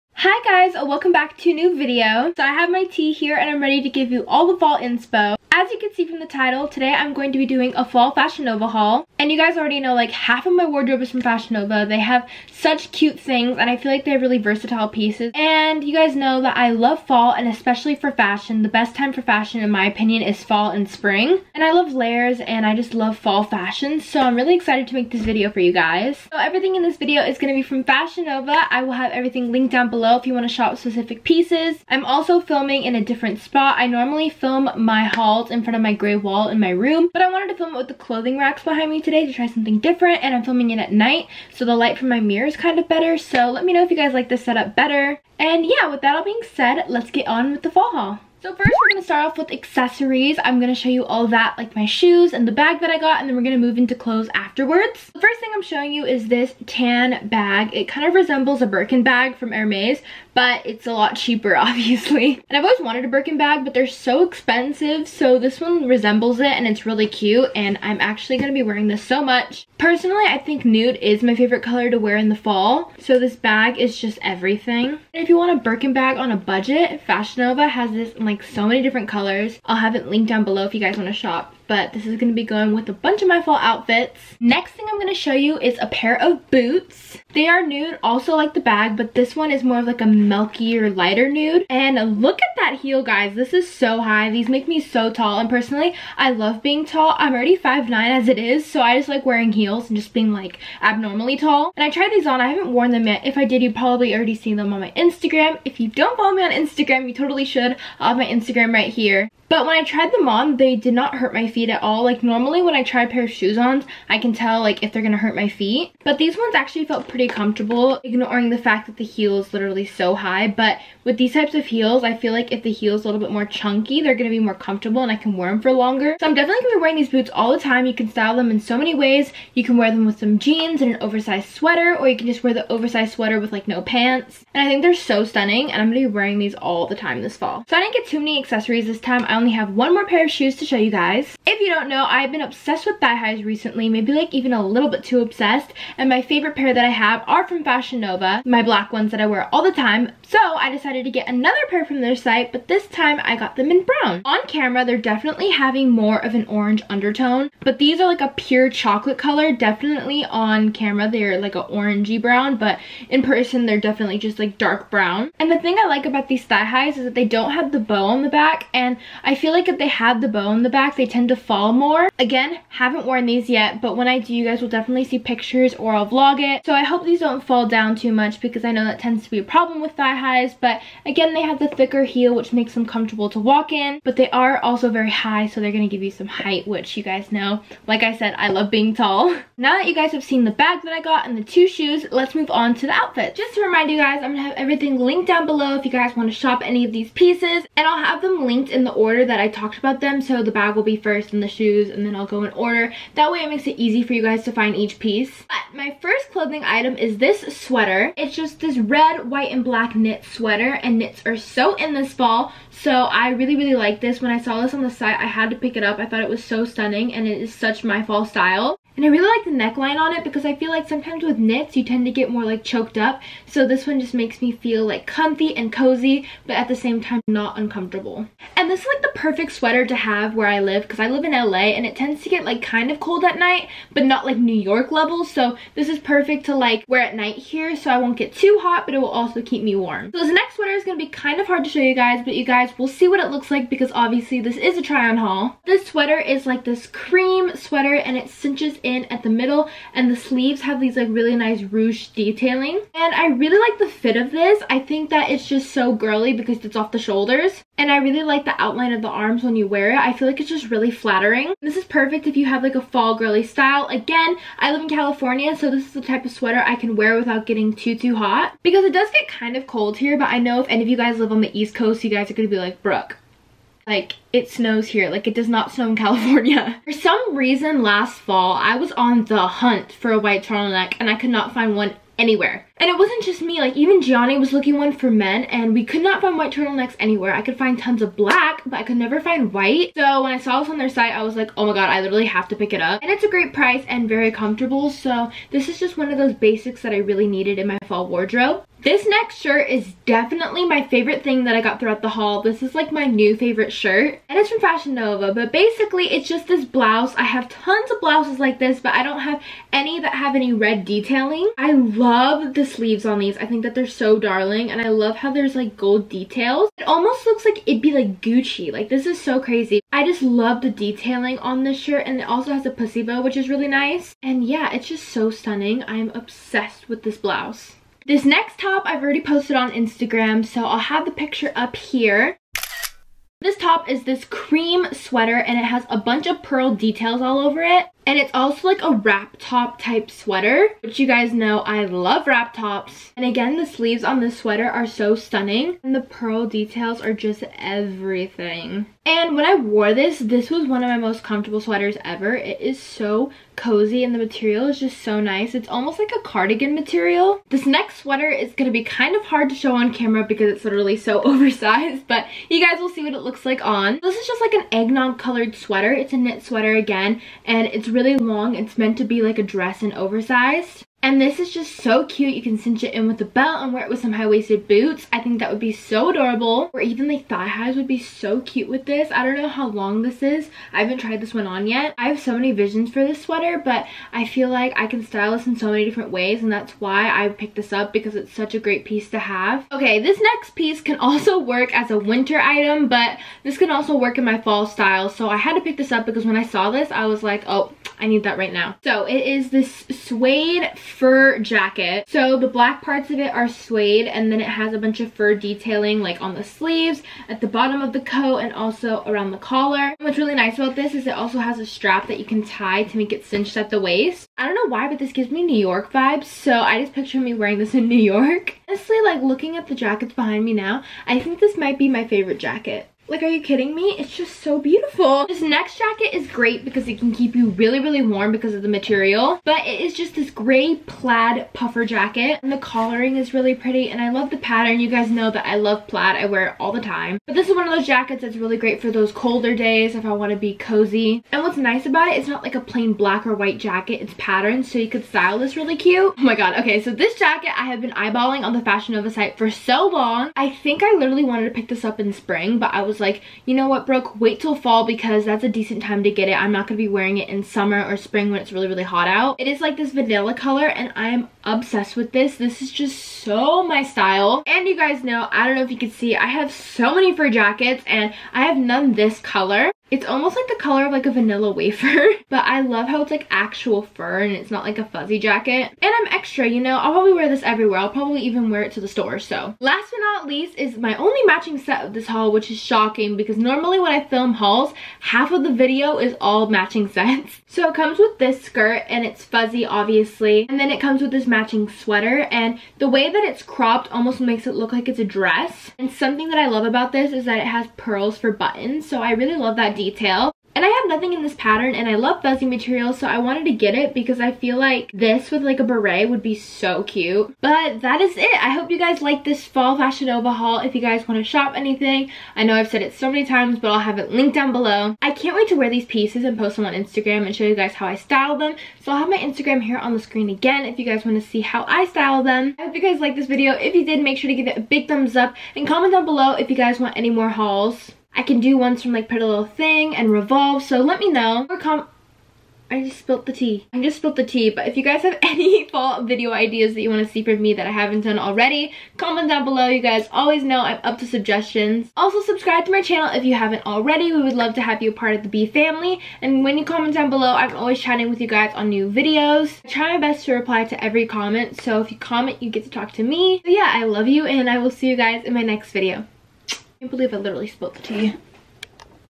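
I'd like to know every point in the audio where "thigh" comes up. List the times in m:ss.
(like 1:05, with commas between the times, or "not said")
2:23, 2:46, 2:59, 6:17.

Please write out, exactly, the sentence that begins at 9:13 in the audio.
But yeah, I love you, and I will see you guys in my next video.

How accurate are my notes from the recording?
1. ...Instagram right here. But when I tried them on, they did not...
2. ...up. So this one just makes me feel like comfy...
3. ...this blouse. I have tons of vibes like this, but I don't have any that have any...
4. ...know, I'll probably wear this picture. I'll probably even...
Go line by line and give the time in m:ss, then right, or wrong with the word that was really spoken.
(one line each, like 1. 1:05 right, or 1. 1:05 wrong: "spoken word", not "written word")
1. 1:48 right
2. 3:42 right
3. 5:06 wrong: "blouses", not "vibes"
4. 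7:56 wrong: "everywhere", not "picture".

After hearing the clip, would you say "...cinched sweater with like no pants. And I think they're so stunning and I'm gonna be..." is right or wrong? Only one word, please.
wrong.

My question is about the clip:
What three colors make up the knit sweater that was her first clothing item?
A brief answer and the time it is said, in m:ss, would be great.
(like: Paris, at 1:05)
red, white, and black, at 3:28.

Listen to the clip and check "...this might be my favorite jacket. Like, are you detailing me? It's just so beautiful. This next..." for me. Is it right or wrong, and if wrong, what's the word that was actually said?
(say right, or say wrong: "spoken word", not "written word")
wrong: "kidding", not "detailing".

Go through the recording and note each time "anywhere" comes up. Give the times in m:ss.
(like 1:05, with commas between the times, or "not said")
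4:42, 4:47.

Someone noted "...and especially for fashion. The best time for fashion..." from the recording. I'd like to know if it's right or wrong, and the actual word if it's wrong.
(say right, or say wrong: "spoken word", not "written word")
right.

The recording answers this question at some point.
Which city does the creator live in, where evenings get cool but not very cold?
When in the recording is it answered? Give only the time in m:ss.
3:51.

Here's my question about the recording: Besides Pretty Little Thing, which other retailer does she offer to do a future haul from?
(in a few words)
Revolve.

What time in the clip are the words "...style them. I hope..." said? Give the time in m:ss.
8:41.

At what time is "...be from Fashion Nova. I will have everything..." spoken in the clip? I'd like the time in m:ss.
0:27.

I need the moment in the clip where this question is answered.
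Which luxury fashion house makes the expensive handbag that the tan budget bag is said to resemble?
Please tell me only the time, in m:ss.
0:59.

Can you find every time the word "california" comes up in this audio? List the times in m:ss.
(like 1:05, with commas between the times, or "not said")
4:24, 4:36.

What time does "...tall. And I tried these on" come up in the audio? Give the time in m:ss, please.
1:41.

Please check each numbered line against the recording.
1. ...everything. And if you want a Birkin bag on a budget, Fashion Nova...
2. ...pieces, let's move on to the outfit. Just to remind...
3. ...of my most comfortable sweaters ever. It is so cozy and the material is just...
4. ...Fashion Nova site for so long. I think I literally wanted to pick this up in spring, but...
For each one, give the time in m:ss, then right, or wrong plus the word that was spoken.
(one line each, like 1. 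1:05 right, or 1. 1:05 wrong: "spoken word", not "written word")
1. 1:14 right
2. 3:11 wrong: "shoes", not "pieces"
3. 5:50 right
4. 7:28 right.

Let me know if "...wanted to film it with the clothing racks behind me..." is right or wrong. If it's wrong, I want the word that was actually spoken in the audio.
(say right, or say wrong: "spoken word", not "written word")
right.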